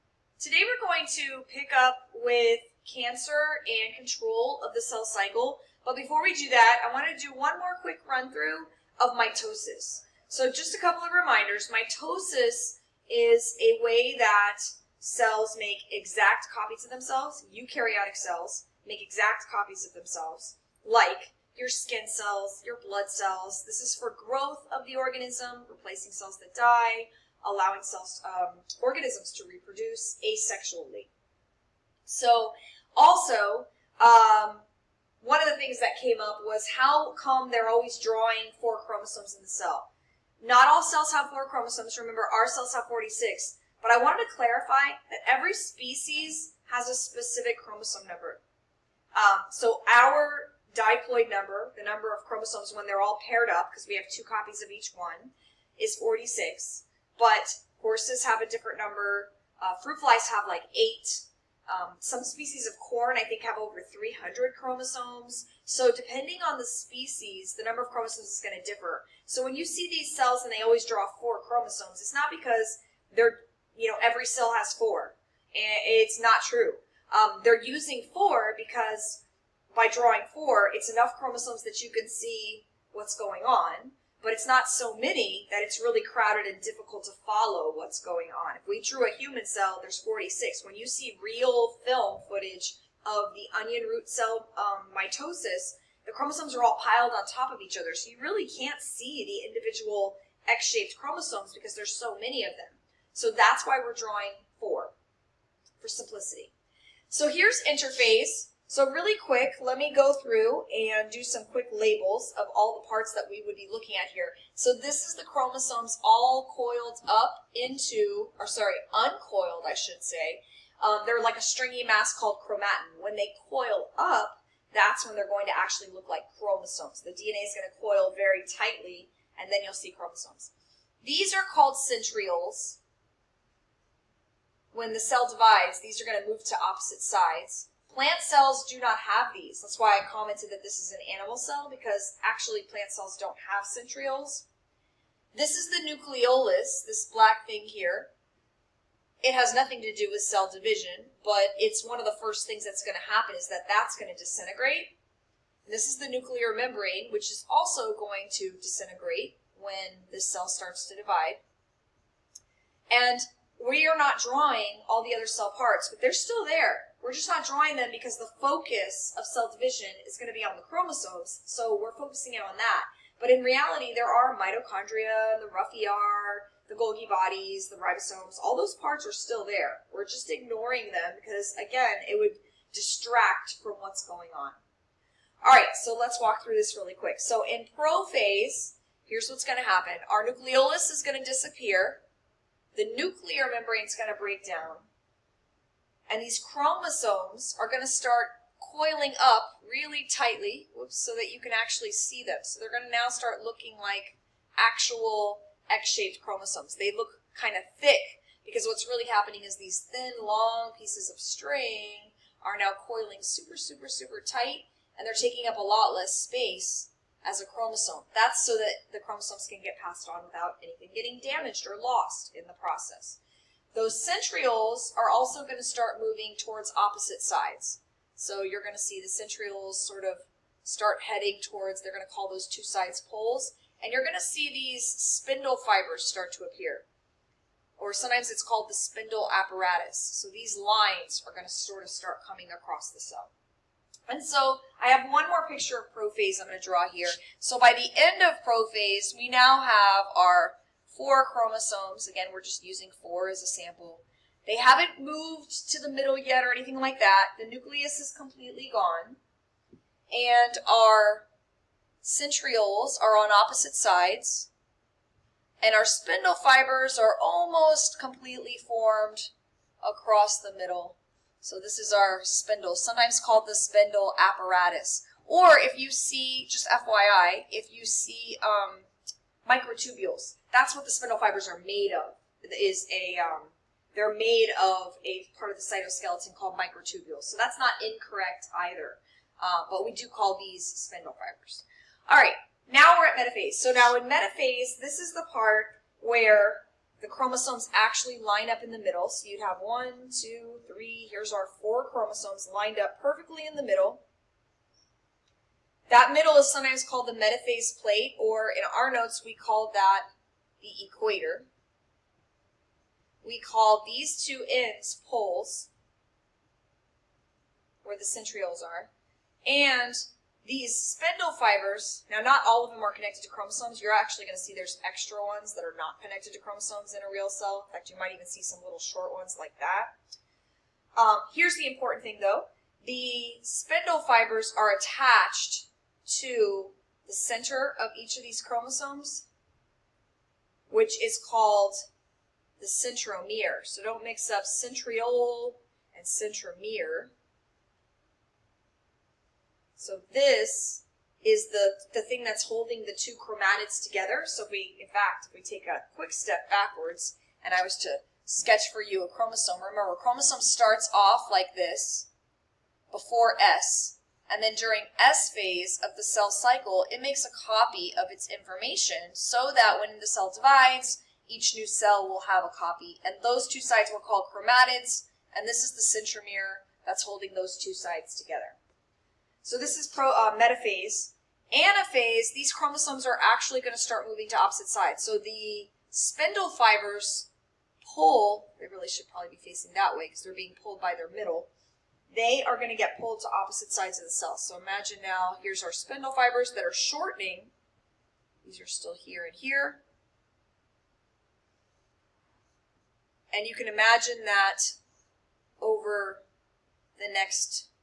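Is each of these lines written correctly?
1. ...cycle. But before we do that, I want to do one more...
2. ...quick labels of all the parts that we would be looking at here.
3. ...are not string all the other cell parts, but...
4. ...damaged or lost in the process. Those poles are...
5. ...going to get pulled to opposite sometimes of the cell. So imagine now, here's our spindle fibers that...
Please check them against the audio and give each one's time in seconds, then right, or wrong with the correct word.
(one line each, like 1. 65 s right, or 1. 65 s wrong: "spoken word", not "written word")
1. 5 s right
2. 111 s right
3. 163 s wrong: "drawing", not "string"
4. 221 s wrong: "centrioles", not "poles"
5. 392 s wrong: "sides", not "sometimes".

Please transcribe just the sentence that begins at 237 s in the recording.
Or sometimes it's called the spindle apparatus.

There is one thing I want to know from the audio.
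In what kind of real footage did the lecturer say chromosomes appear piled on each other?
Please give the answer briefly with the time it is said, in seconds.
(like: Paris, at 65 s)
onion root cell, at 93 s.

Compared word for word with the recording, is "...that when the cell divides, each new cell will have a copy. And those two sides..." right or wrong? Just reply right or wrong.
right.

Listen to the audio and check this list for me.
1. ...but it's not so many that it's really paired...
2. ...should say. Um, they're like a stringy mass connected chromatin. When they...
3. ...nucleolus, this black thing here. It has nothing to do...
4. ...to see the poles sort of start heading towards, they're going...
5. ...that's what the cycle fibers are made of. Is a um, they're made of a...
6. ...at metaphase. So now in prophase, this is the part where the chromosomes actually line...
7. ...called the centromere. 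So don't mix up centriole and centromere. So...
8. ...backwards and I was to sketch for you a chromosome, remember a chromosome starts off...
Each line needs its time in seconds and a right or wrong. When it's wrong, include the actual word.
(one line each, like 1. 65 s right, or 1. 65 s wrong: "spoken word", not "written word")
1. 84 s wrong: "crowded", not "paired"
2. 119 s wrong: "called", not "connected"
3. 145 s right
4. 228 s wrong: "centrioles", not "poles"
5. 280 s wrong: "spindle", not "cycle"
6. 293 s wrong: "metaphase", not "prophase"
7. 341 s right
8. 356 s right.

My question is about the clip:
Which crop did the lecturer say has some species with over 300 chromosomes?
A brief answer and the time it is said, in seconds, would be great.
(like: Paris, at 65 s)
corn, at 62 s.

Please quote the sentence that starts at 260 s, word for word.
And our centrioles are on opposite sides.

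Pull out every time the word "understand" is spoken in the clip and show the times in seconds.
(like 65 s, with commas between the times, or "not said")
not said.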